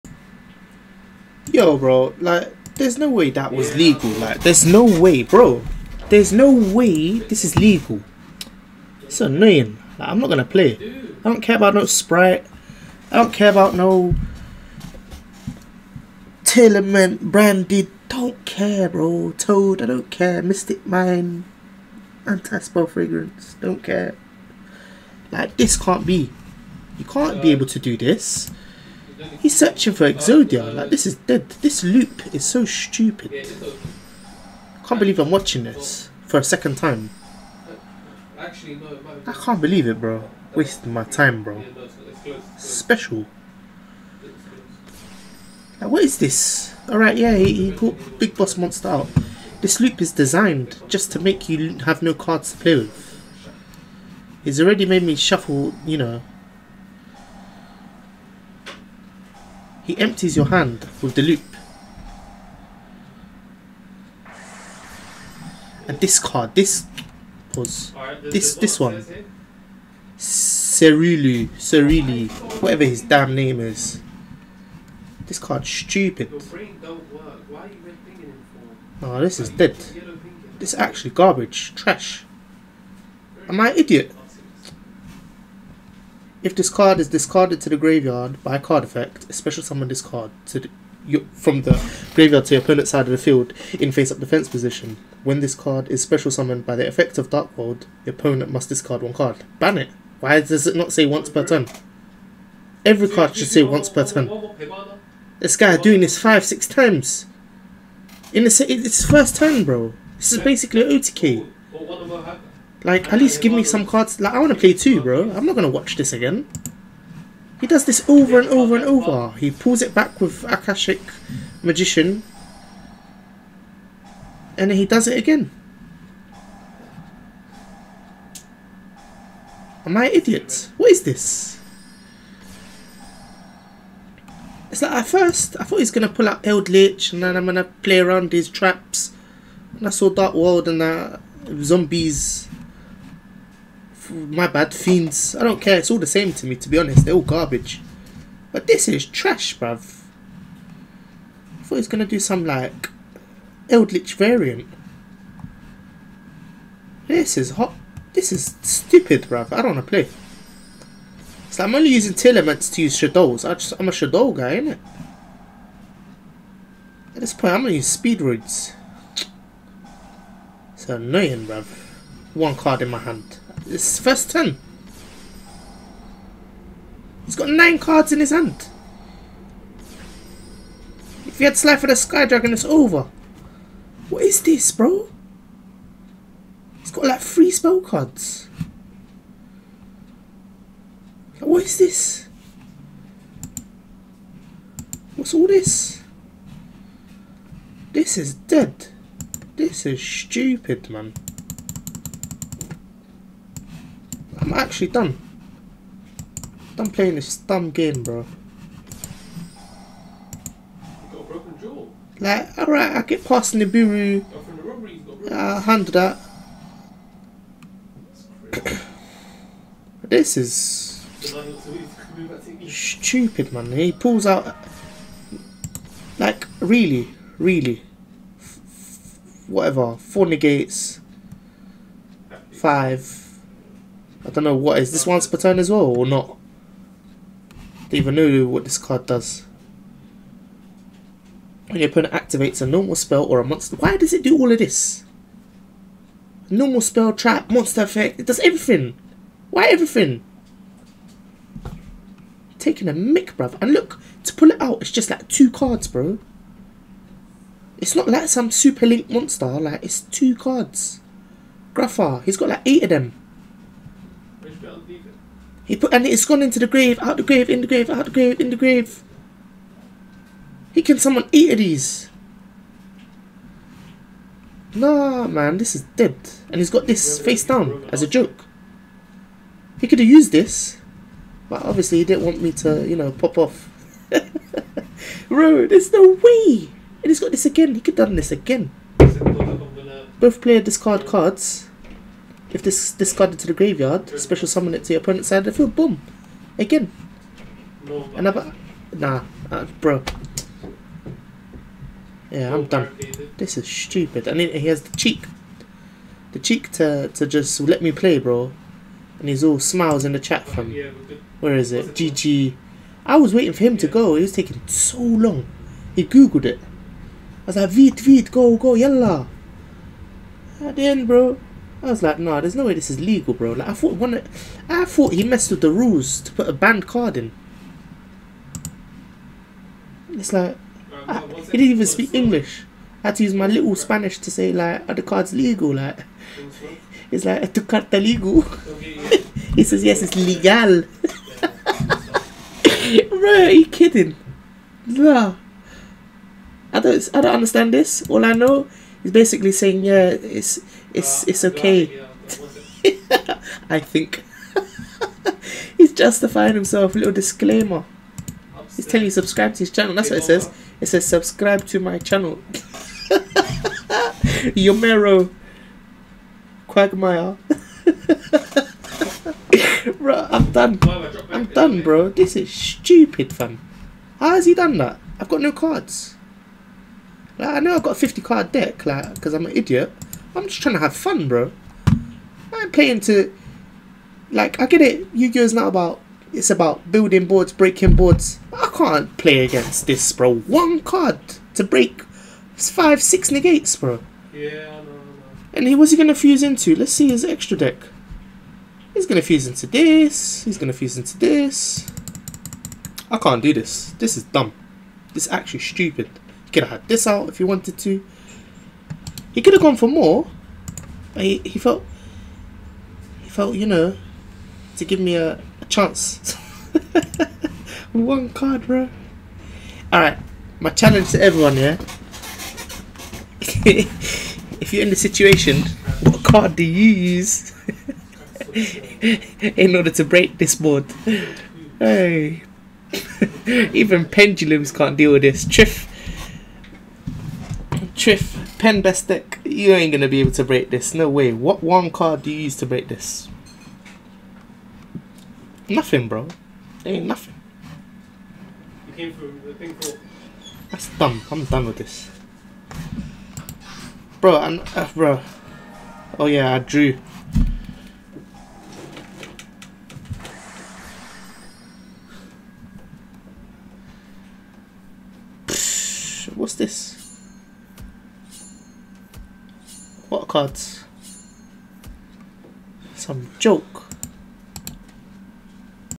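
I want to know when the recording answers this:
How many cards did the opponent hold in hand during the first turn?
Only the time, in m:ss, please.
2:57.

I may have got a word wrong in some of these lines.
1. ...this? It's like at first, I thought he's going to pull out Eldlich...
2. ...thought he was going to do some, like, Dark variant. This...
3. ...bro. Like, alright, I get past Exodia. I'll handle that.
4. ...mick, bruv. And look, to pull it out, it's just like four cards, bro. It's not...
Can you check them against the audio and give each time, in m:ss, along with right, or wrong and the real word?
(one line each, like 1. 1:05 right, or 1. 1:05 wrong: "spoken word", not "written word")
1. 2:11 right
2. 2:31 wrong: "Eldritch", not "Dark"
3. 3:28 wrong: "Nibiru", not "Exodia"
4. 4:12 wrong: "two", not "four".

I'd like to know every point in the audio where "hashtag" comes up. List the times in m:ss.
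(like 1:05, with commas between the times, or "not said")
not said.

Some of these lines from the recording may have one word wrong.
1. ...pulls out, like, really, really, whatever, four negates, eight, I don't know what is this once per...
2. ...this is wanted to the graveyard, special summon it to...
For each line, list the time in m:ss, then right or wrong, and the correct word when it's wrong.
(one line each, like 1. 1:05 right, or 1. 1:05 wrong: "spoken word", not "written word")
1. 3:43 wrong: "five", not "eight"
2. 4:52 wrong: "discarded", not "wanted".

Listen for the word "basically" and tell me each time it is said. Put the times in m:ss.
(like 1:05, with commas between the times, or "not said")
1:50, 5:49.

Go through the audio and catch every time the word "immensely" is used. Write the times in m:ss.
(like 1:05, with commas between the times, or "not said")
not said.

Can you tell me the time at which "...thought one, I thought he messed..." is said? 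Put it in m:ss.
5:23.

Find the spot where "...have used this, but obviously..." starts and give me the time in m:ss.
4:39.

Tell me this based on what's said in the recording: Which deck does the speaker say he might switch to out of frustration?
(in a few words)
Speedroids.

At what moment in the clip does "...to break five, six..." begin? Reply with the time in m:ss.
6:31.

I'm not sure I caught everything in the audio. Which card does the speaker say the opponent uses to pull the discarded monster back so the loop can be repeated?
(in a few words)
Akashic Magician.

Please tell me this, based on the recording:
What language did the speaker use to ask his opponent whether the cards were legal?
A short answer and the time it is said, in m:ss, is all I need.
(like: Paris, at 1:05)
Spanish, at 5:33.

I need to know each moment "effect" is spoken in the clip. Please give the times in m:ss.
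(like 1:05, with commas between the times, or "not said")
1:28, 1:36, 4:07.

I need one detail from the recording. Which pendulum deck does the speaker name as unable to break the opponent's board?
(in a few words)
Triff pen.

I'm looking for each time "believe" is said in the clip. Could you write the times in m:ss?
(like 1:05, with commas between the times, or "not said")
0:34, 0:39.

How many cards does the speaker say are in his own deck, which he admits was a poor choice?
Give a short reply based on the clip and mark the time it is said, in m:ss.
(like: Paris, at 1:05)
50, at 6:17.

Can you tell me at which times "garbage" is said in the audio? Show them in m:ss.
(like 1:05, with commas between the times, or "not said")
1:21, 2:27.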